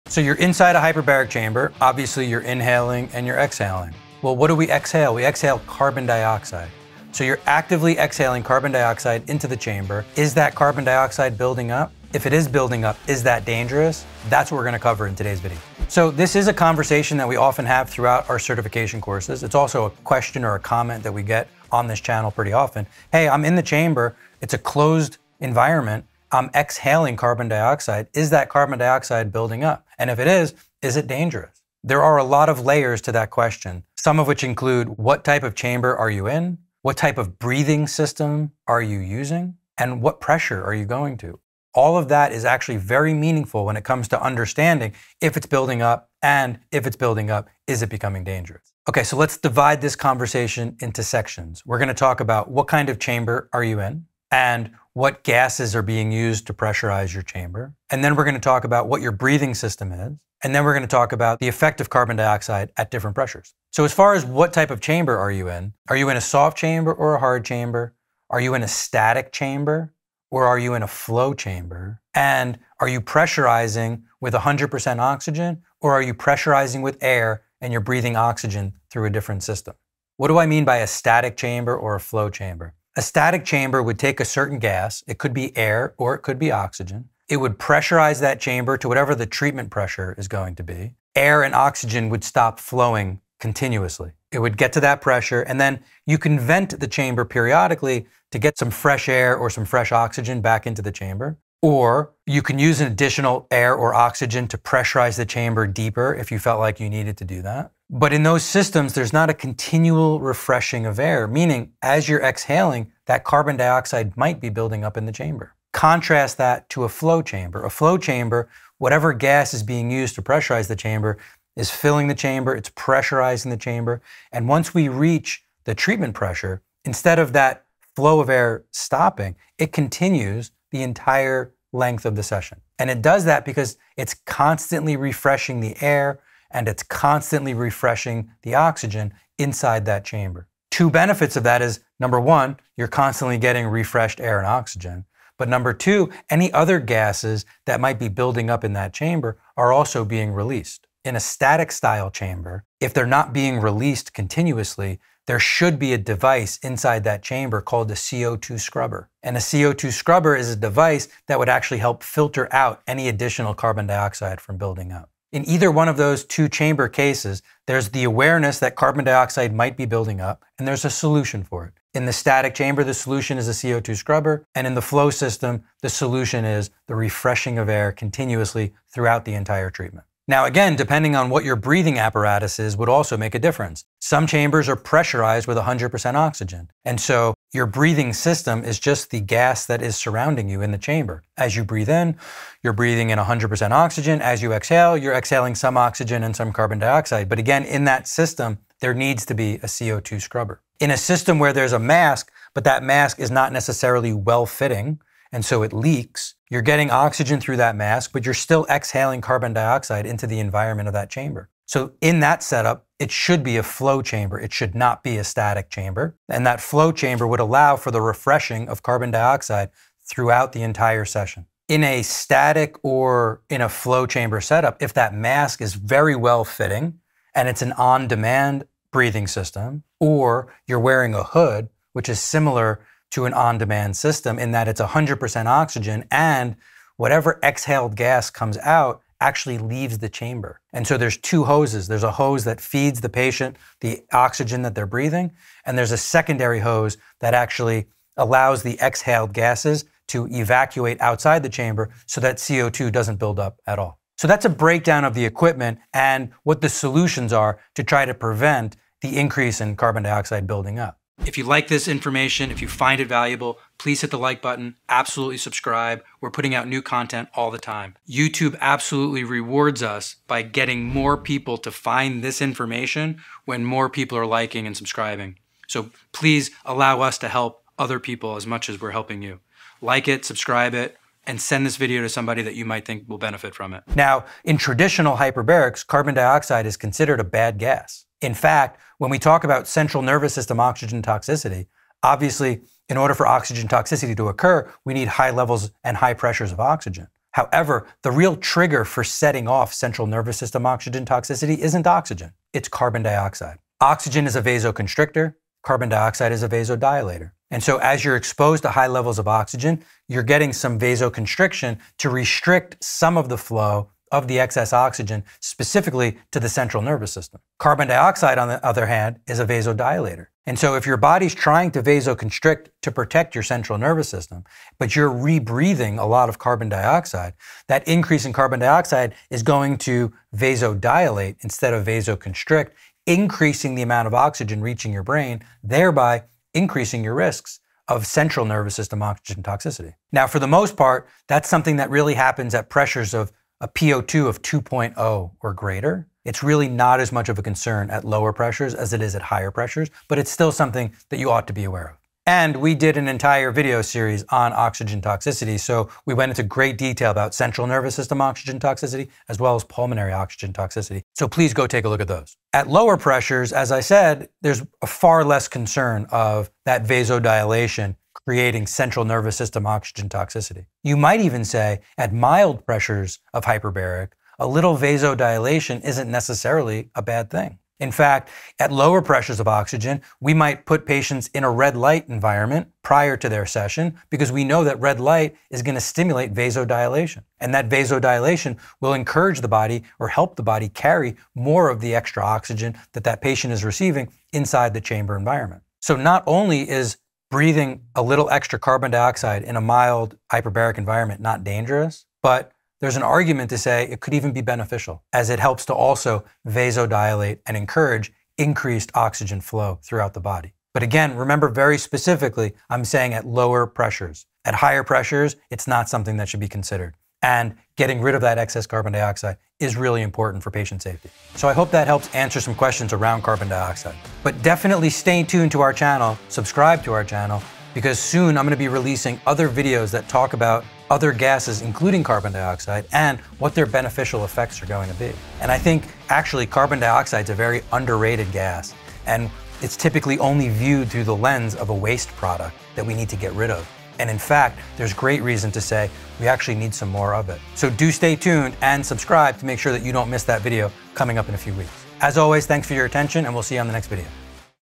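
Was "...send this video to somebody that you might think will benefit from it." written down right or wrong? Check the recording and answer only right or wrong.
right.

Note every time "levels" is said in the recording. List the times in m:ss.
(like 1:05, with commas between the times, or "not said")
4:55, 5:08.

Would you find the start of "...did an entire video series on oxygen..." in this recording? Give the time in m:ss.
5:52.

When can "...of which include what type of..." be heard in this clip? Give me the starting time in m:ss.
0:34.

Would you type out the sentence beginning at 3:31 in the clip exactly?
So in that setup, it should be a flow chamber.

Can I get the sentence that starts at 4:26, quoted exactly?
We're putting out new content all the time.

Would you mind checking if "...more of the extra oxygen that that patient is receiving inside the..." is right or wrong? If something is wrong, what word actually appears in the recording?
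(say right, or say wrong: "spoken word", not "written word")
right.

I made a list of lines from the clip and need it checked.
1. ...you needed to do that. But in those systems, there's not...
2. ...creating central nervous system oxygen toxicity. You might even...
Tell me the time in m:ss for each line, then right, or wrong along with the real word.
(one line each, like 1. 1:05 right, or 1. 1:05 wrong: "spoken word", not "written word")
1. 1:46 right
2. 6:08 right.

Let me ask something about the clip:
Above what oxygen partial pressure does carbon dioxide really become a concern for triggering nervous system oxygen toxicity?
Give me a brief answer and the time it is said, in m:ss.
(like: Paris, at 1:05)
2.0, at 5:44.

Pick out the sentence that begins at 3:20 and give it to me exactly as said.
In a system where there's a mask, but that mask is not necessarily well fitting, and so it leaks.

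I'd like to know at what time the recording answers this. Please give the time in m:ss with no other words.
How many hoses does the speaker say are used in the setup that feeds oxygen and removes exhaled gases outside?
4:01.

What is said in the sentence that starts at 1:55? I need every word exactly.
Contrast that to a flow chamber.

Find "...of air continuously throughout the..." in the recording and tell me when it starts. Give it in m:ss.
2:57.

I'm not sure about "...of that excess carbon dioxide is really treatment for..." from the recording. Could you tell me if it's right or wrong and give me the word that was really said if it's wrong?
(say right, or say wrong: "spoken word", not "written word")
wrong: "important", not "treatment".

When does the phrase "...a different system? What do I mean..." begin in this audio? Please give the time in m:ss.
1:19.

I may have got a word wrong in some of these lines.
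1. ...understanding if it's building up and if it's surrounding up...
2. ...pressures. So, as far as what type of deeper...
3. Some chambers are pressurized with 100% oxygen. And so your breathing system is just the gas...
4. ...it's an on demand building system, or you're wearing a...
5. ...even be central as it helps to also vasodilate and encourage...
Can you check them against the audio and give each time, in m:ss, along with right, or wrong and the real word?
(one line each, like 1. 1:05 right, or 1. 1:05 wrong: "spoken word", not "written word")
1. 0:44 wrong: "building", not "surrounding"
2. 1:03 wrong: "chamber", not "deeper"
3. 3:03 right
4. 3:47 wrong: "breathing", not "building"
5. 6:44 wrong: "beneficial", not "central".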